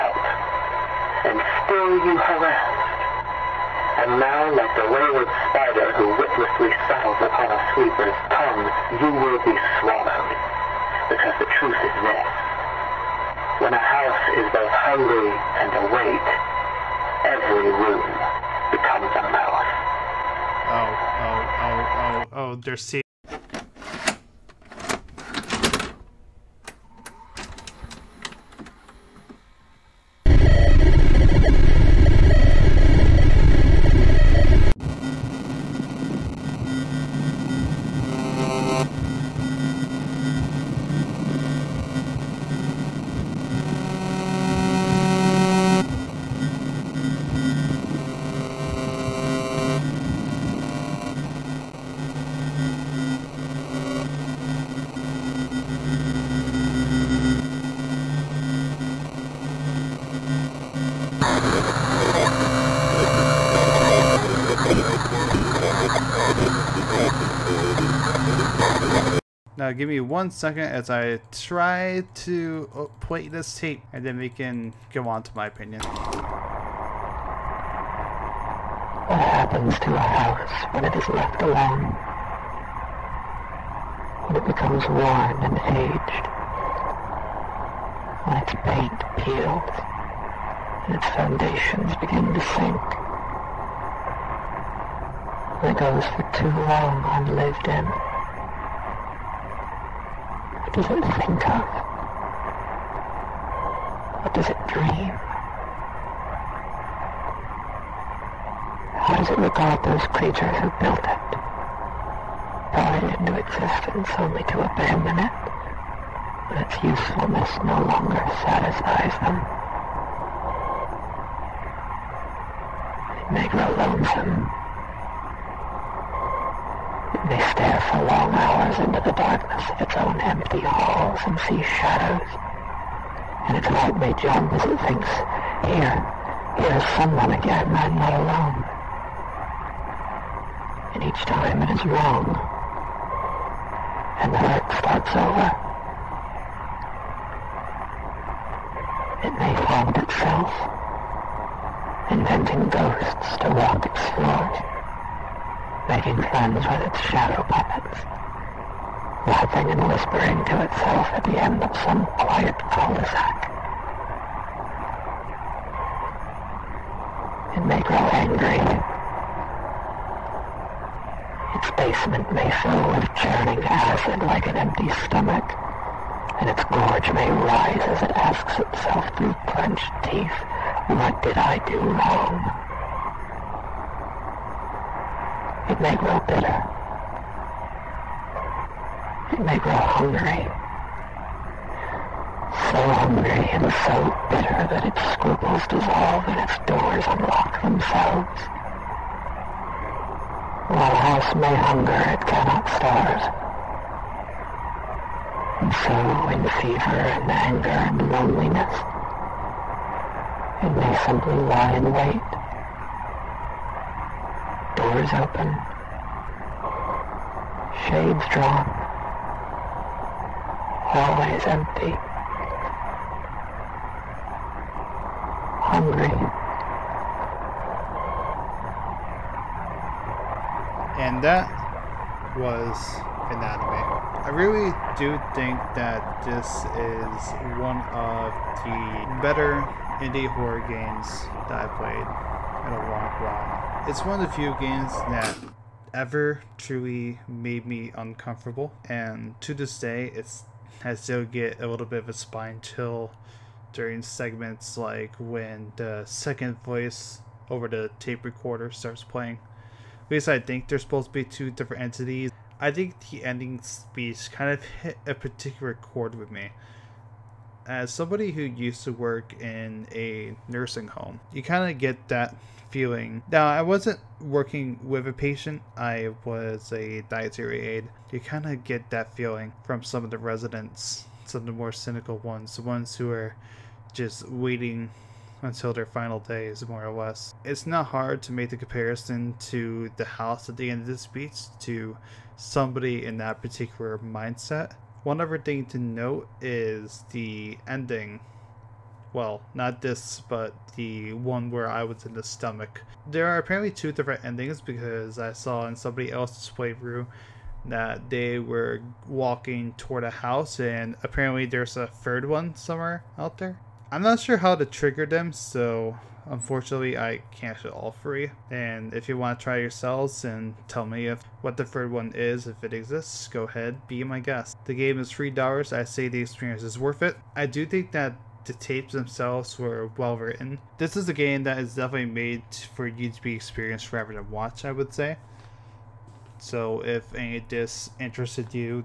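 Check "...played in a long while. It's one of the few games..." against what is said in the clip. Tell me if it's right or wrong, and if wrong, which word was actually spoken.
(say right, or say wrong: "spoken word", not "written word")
right.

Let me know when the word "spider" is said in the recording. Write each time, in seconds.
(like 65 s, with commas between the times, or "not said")
5 s.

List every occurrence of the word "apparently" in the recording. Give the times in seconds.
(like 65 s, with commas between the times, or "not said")
303 s, 311 s.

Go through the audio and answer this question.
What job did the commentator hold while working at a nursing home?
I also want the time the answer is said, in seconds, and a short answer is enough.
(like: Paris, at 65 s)
dietary aide, at 277 s.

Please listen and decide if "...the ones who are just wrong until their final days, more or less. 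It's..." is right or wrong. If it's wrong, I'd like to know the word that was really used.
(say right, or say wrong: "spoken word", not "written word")
wrong: "waiting", not "wrong".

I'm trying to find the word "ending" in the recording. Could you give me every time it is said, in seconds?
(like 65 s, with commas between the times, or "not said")
263 s, 297 s, 304 s.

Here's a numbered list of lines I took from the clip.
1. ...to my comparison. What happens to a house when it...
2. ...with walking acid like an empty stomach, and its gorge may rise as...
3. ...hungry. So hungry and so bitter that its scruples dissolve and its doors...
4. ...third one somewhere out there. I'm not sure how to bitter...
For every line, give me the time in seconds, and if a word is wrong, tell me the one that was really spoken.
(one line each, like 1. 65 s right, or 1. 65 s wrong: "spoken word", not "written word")
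1. 75 s wrong: "opinion", not "comparison"
2. 172 s wrong: "churning", not "walking"
3. 189 s right
4. 311 s wrong: "trigger", not "bitter".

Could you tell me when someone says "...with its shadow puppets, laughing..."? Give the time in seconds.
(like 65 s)
156 s.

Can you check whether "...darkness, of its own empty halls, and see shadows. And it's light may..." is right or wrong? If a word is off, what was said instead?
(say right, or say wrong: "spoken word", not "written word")
right.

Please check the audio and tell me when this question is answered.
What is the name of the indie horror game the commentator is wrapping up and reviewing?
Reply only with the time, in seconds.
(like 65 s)
233 s.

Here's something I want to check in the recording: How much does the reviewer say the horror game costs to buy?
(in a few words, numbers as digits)
$3.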